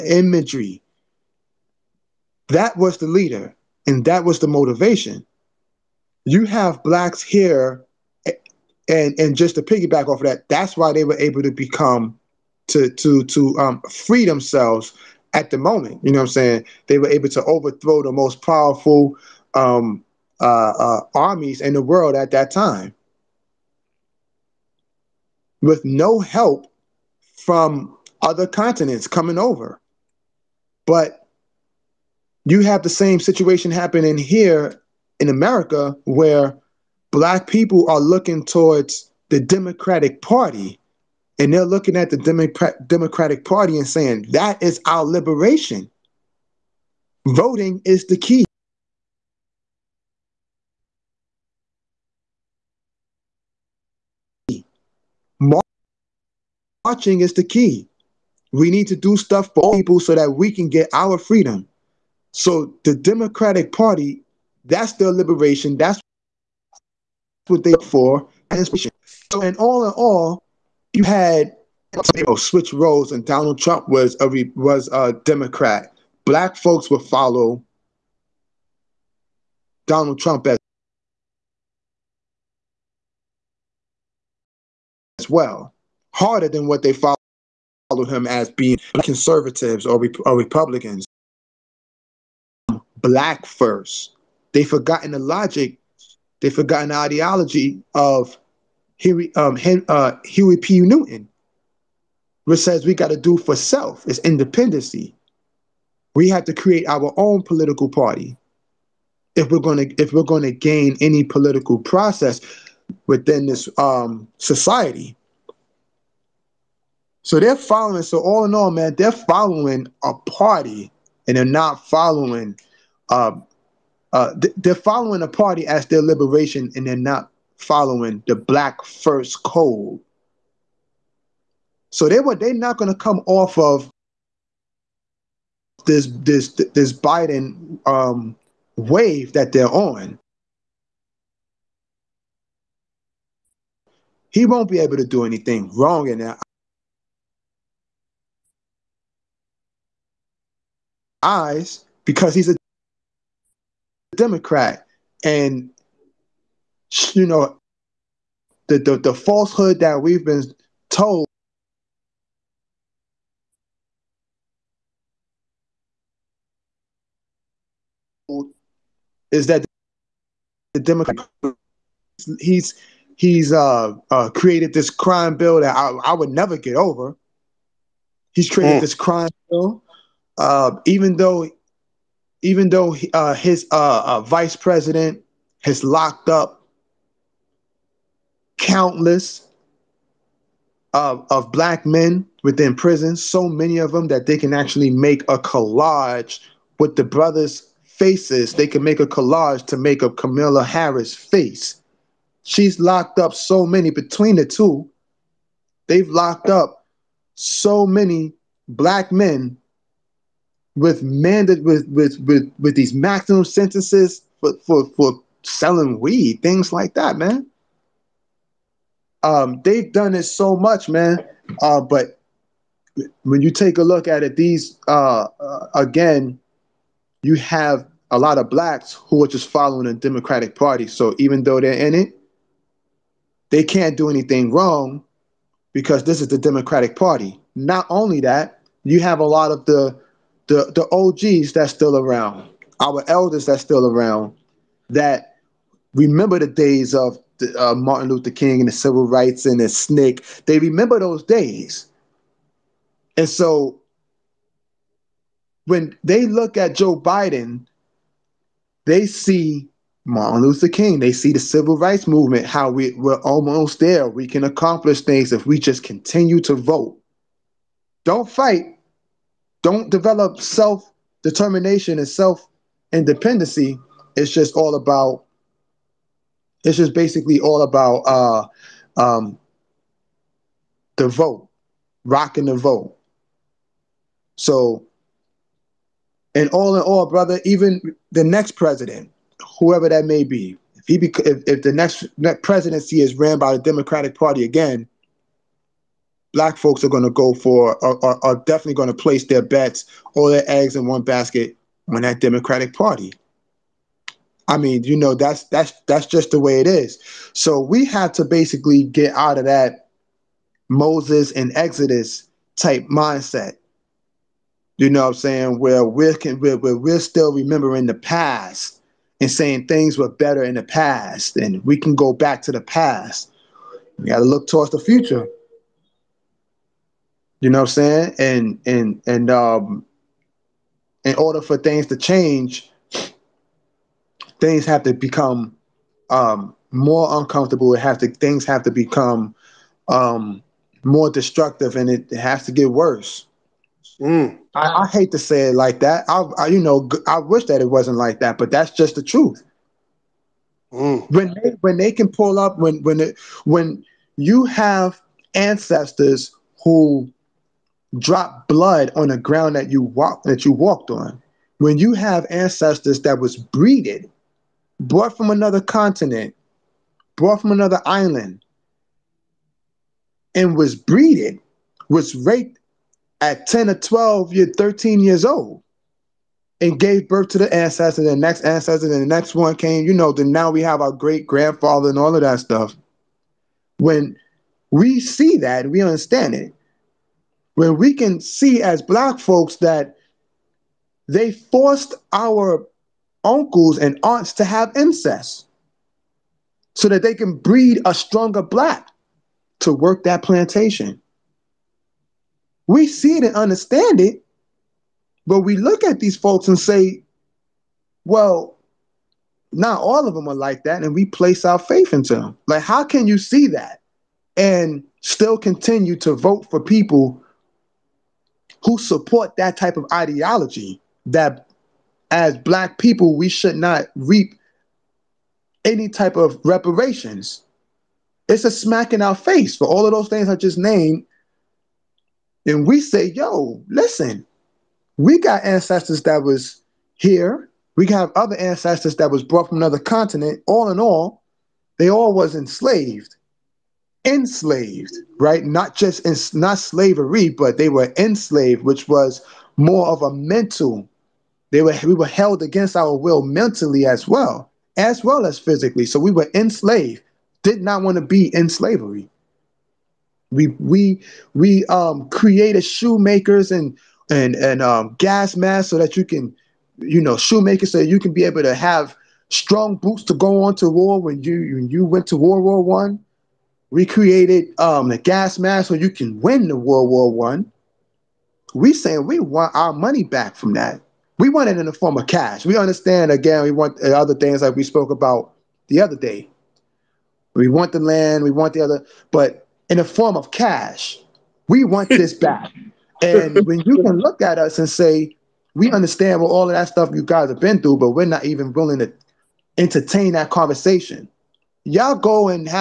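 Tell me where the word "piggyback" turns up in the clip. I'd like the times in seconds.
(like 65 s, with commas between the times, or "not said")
9 s.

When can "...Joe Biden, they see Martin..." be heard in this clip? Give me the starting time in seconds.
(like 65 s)
256 s.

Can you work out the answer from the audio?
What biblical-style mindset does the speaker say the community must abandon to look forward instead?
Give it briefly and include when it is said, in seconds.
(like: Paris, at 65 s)
Moses and Exodus, at 310 s.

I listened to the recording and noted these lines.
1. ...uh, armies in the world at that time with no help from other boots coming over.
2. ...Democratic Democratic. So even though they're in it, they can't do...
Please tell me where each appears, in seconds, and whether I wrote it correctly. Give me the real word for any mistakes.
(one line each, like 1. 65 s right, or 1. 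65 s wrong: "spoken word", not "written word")
1. 20 s wrong: "continents", not "boots"
2. 229 s wrong: "Party", not "Democratic".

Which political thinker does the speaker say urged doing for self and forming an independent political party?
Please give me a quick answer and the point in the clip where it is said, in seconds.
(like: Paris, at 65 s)
Huey P. Newton, at 100 s.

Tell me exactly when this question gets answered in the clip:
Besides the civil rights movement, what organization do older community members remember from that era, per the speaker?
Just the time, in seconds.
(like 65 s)
249 s.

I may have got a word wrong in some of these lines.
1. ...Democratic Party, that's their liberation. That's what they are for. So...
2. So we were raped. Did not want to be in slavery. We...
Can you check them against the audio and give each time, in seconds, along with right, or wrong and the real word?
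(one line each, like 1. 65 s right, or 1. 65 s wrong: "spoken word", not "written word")
1. 62 s right
2. 455 s wrong: "enslaved", not "raped".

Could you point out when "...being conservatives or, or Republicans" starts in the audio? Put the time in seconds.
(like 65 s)
88 s.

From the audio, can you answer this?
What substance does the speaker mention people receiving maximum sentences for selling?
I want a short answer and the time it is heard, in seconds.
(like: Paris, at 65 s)
weed, at 215 s.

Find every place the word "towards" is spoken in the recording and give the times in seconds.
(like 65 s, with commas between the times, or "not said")
38 s, 324 s.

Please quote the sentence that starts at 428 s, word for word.
It's a smack in our face for all of those things I just named.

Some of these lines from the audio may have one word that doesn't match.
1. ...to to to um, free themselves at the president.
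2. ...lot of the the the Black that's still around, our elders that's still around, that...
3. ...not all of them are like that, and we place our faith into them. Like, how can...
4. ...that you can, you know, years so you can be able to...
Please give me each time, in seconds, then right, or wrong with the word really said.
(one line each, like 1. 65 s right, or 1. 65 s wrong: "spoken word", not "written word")
1. 12 s wrong: "moment", not "president"
2. 239 s wrong: "OGs", not "Black"
3. 409 s right
4. 465 s wrong: "shoemakers", not "years".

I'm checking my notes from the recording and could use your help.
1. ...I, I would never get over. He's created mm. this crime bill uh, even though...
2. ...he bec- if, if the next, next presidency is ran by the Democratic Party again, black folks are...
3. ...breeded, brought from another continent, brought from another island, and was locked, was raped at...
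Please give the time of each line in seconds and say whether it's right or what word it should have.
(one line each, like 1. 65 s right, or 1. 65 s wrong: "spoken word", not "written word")
1. 175 s right
2. 290 s right
3. 363 s wrong: "breeded", not "locked".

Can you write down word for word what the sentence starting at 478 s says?
We saying we want our money back from that.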